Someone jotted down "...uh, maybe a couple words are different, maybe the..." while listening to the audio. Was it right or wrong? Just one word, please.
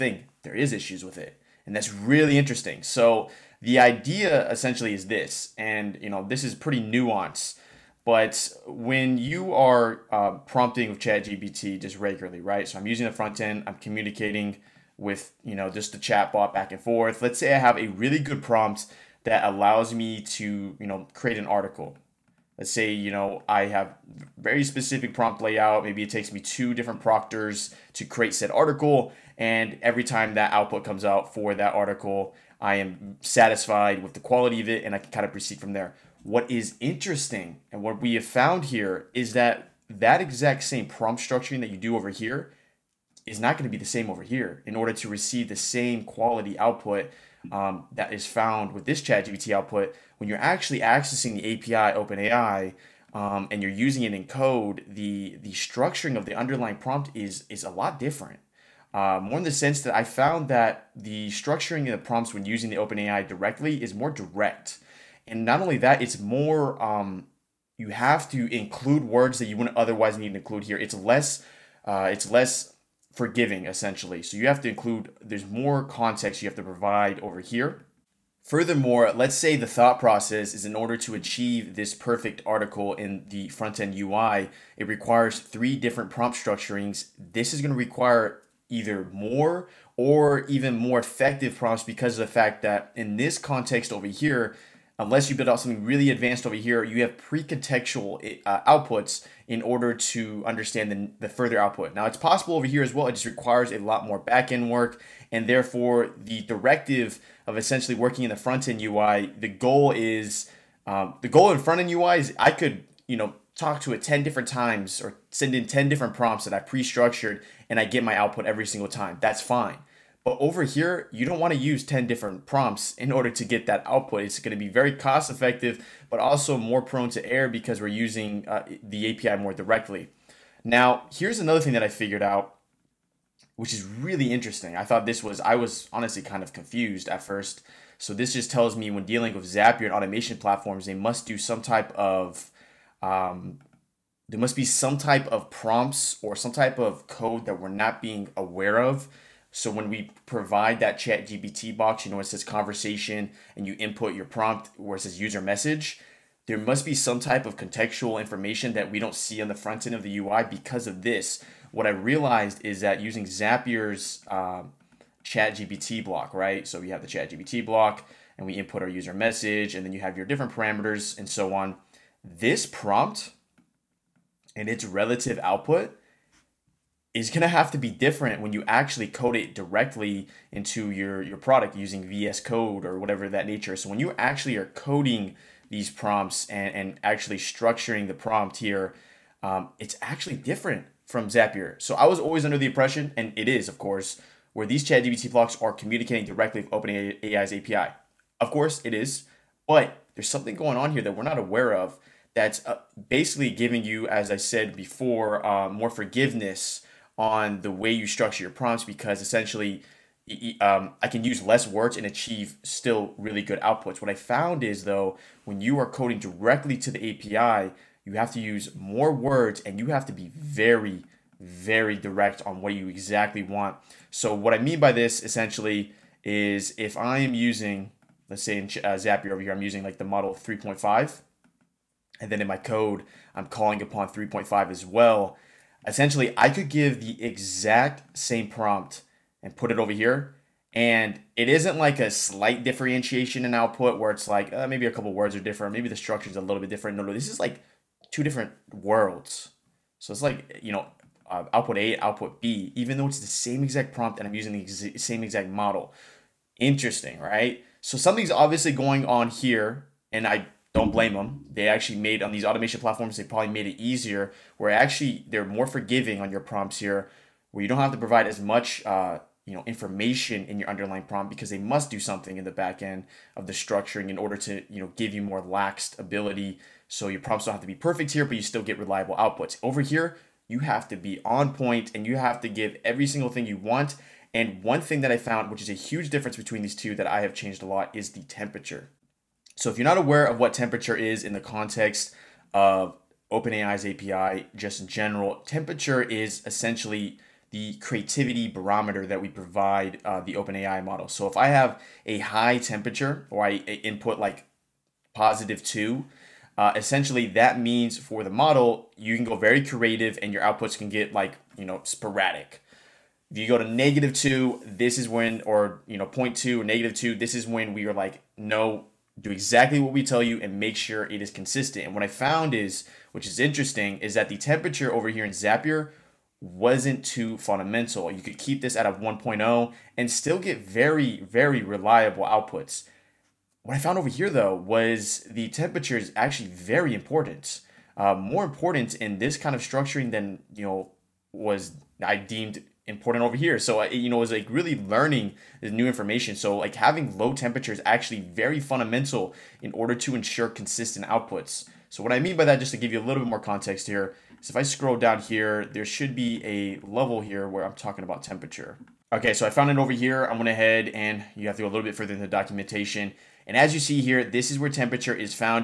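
right.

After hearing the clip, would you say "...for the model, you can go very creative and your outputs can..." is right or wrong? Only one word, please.
right.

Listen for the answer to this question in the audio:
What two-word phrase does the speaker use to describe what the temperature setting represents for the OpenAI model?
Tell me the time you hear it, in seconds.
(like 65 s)
297 s.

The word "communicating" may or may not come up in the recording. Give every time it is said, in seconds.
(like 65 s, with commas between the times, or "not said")
13 s, 195 s.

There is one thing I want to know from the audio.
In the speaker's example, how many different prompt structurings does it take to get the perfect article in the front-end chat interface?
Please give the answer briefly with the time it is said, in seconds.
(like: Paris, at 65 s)
3, at 85 s.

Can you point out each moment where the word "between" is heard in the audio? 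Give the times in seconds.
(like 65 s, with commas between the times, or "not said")
286 s.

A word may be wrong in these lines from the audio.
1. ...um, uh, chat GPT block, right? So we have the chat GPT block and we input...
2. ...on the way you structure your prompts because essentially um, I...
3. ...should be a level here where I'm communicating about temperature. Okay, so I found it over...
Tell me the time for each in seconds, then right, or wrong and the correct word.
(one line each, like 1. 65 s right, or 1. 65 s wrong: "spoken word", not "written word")
1. 164 s right
2. 207 s right
3. 355 s wrong: "talking", not "communicating".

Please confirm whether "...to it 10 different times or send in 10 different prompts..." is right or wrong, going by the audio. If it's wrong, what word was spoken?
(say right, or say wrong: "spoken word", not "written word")
right.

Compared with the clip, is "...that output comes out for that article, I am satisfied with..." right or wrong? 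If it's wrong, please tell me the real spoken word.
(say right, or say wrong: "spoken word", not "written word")
right.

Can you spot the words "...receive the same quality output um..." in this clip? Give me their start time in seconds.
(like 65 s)
45 s.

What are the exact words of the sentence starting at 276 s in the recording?
So your prompts don't have to be perfect here, but you still get reliable outputs.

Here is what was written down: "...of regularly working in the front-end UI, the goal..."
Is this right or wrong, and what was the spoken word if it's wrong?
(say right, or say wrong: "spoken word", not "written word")
wrong: "essentially", not "regularly".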